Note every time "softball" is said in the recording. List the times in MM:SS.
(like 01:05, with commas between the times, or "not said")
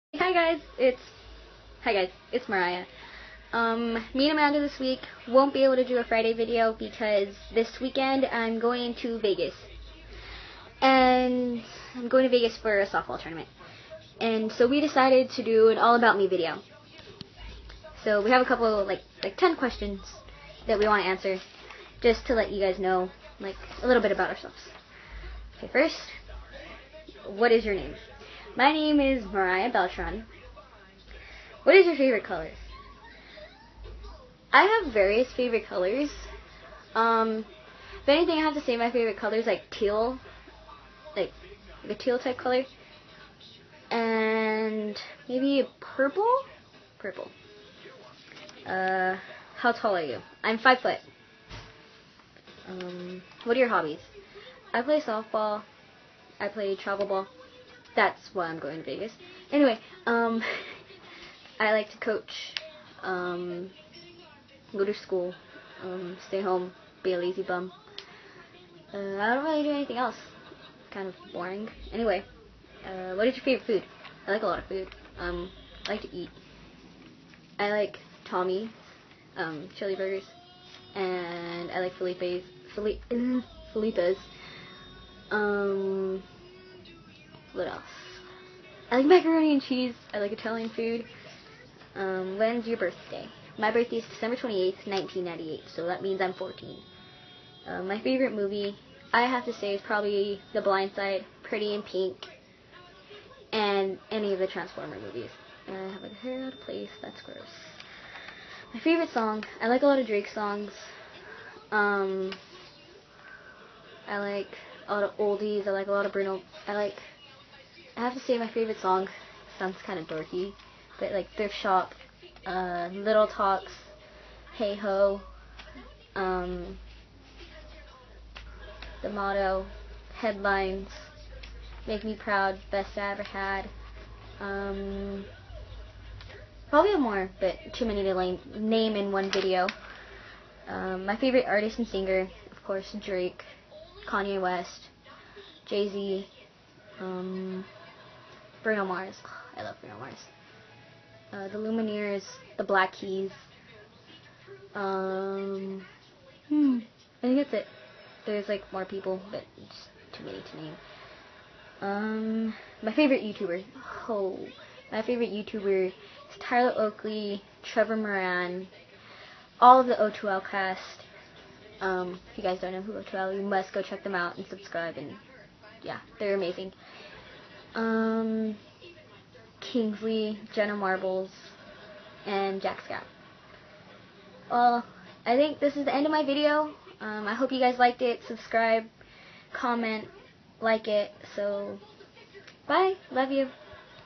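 00:12, 00:54.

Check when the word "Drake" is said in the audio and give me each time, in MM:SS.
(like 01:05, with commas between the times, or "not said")
01:50, 02:22.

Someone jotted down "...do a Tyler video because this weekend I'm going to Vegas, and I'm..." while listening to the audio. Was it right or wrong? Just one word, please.
wrong.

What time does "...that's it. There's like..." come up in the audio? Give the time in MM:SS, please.
02:37.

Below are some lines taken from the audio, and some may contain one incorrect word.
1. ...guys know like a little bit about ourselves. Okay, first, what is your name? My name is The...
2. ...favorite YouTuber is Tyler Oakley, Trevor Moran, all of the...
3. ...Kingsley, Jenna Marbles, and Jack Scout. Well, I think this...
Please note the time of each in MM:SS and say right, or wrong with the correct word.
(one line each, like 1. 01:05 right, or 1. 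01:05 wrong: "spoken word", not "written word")
1. 00:22 wrong: "Mariah", not "The"
2. 02:45 right
3. 02:59 right.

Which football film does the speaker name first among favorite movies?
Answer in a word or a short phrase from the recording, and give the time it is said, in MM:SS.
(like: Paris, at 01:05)
The Blind Side, at 01:40.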